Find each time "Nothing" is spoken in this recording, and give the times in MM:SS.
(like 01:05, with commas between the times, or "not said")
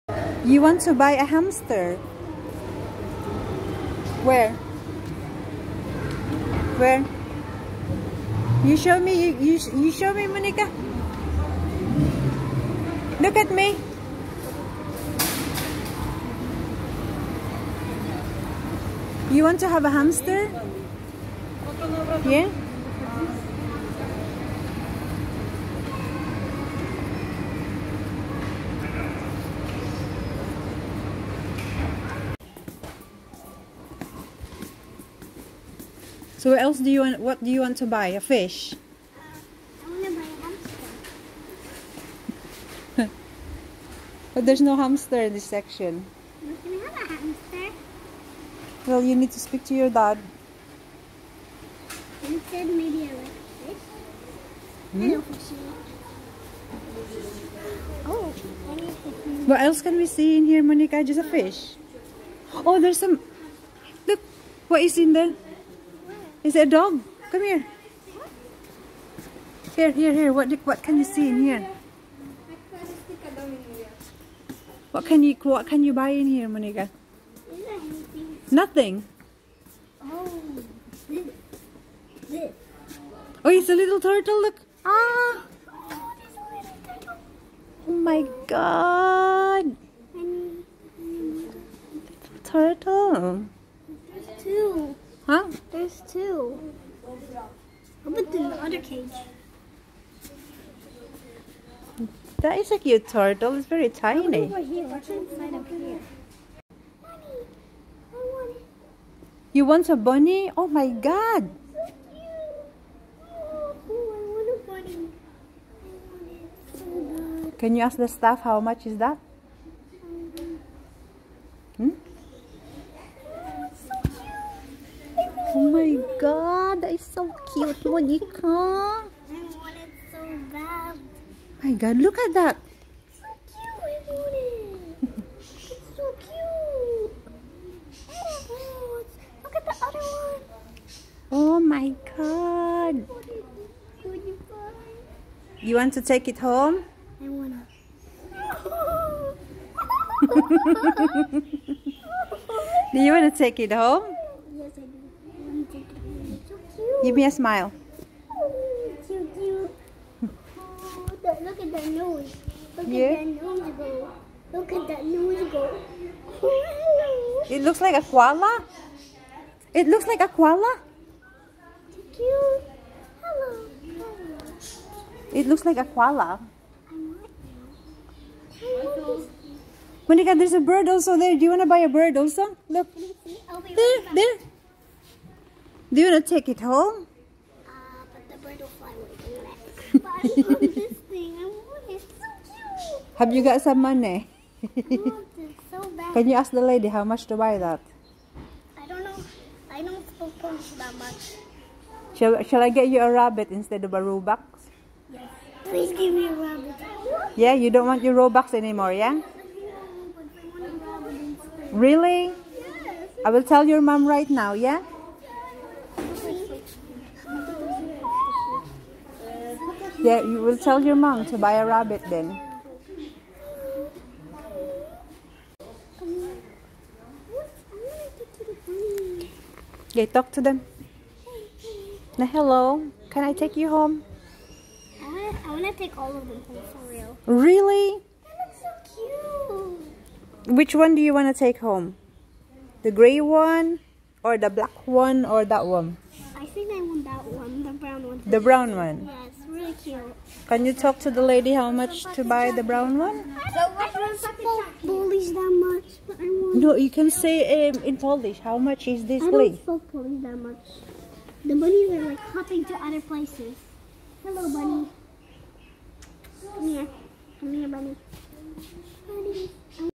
01:18.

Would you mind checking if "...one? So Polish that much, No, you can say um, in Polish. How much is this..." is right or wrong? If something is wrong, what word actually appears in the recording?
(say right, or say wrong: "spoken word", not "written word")
right.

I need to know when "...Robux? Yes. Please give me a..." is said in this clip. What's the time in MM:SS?
03:23.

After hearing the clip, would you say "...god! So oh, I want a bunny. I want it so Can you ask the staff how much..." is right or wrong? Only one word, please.
right.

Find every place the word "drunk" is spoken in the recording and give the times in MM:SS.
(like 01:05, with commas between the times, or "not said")
not said.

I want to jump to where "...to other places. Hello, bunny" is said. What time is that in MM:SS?
04:22.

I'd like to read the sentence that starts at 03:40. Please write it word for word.
Yeah, you will tell your mom to buy a rabbit then.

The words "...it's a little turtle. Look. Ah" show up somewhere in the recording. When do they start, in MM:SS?
01:23.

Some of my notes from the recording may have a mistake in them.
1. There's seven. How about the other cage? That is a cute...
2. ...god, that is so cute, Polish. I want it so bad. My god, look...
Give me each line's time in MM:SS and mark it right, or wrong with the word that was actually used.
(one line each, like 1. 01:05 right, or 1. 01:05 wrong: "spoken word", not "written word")
1. 01:35 wrong: "two", not "seven"
2. 02:06 wrong: "Monika", not "Polish".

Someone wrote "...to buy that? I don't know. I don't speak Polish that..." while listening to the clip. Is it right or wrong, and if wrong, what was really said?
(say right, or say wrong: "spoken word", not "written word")
right.